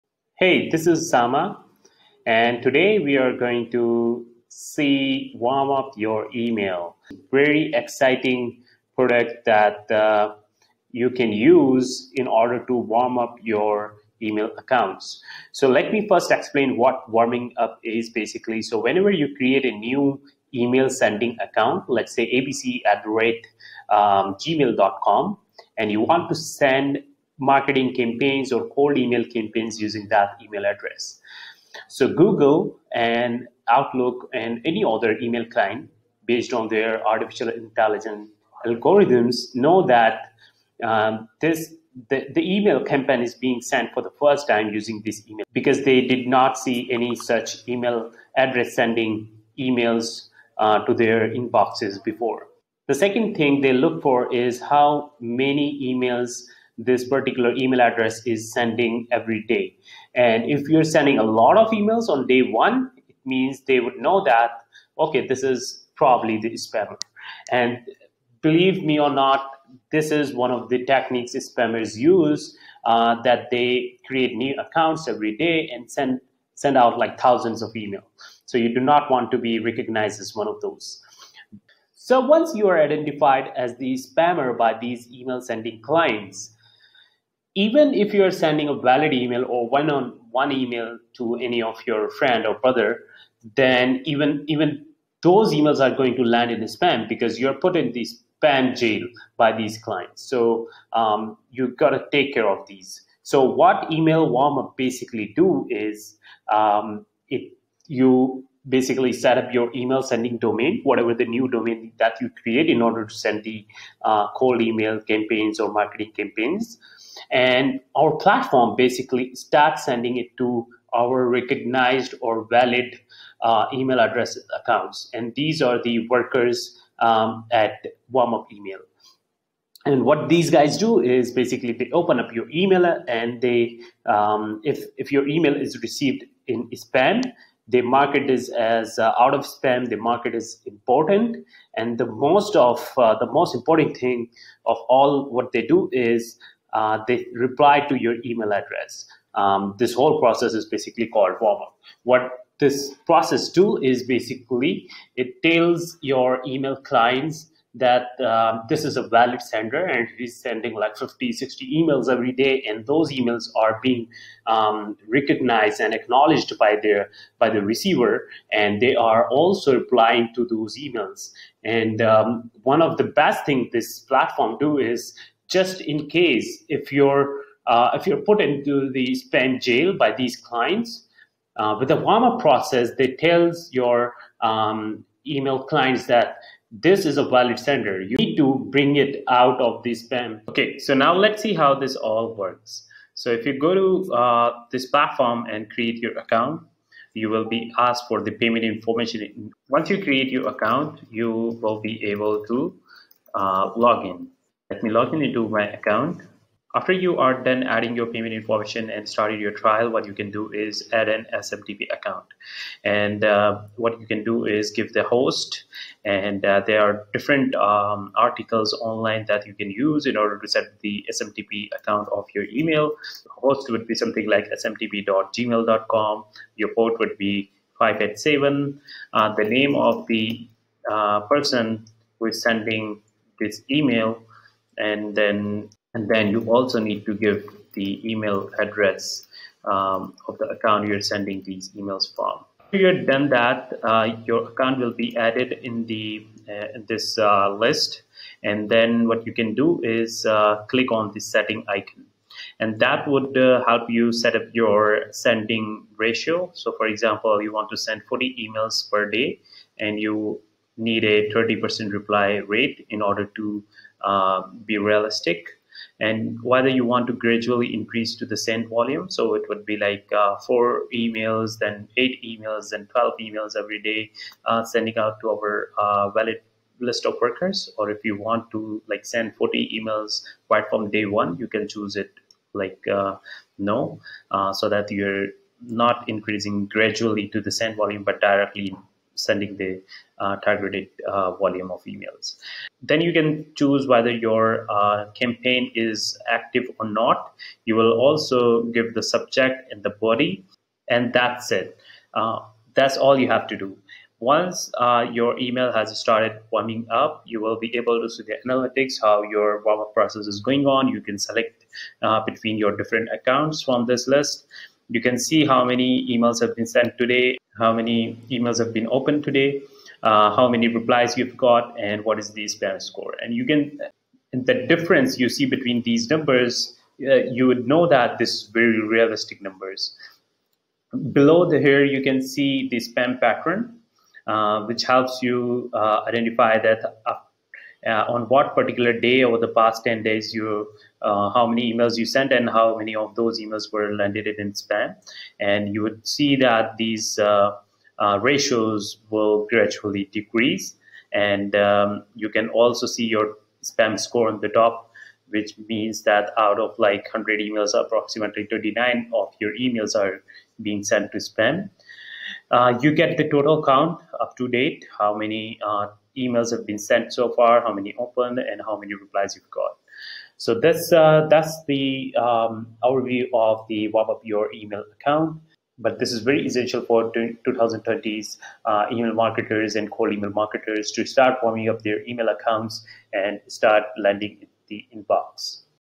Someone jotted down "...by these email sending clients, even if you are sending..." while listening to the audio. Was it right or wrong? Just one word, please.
right.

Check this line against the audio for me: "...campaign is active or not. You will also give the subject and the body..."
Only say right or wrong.
right.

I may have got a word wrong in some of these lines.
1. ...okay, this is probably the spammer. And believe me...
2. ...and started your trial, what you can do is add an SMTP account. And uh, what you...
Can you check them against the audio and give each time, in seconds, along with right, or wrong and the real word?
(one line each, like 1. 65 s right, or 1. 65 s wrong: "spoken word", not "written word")
1. 64 s right
2. 208 s right.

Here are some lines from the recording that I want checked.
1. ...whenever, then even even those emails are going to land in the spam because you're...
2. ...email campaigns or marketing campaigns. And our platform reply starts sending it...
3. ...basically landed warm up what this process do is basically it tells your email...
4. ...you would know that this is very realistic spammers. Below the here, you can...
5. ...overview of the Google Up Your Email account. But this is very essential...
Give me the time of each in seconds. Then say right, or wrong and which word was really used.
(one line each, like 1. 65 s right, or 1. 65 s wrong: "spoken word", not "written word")
1. 92 s wrong: "brother", not "whenever"
2. 114 s wrong: "basically", not "reply"
3. 150 s wrong: "called", not "landed"
4. 327 s wrong: "numbers", not "spammers"
5. 372 s wrong: "Warm", not "Google".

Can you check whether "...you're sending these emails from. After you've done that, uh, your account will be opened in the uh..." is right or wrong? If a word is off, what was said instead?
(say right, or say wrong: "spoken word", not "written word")
wrong: "added", not "opened".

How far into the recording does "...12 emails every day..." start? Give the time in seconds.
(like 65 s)
272 s.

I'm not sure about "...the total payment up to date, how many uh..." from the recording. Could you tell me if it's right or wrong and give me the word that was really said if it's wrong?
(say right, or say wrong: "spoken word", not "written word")
wrong: "count", not "payment".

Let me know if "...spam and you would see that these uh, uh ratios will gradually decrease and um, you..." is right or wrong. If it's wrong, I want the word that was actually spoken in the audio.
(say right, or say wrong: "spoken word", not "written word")
right.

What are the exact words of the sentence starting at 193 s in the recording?
So if you go to uh, this platform and create your account, you will be asked for the payment information.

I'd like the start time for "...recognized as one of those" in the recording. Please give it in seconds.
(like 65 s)
79 s.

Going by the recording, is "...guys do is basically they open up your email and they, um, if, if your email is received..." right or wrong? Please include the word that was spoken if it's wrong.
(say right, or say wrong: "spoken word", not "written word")
right.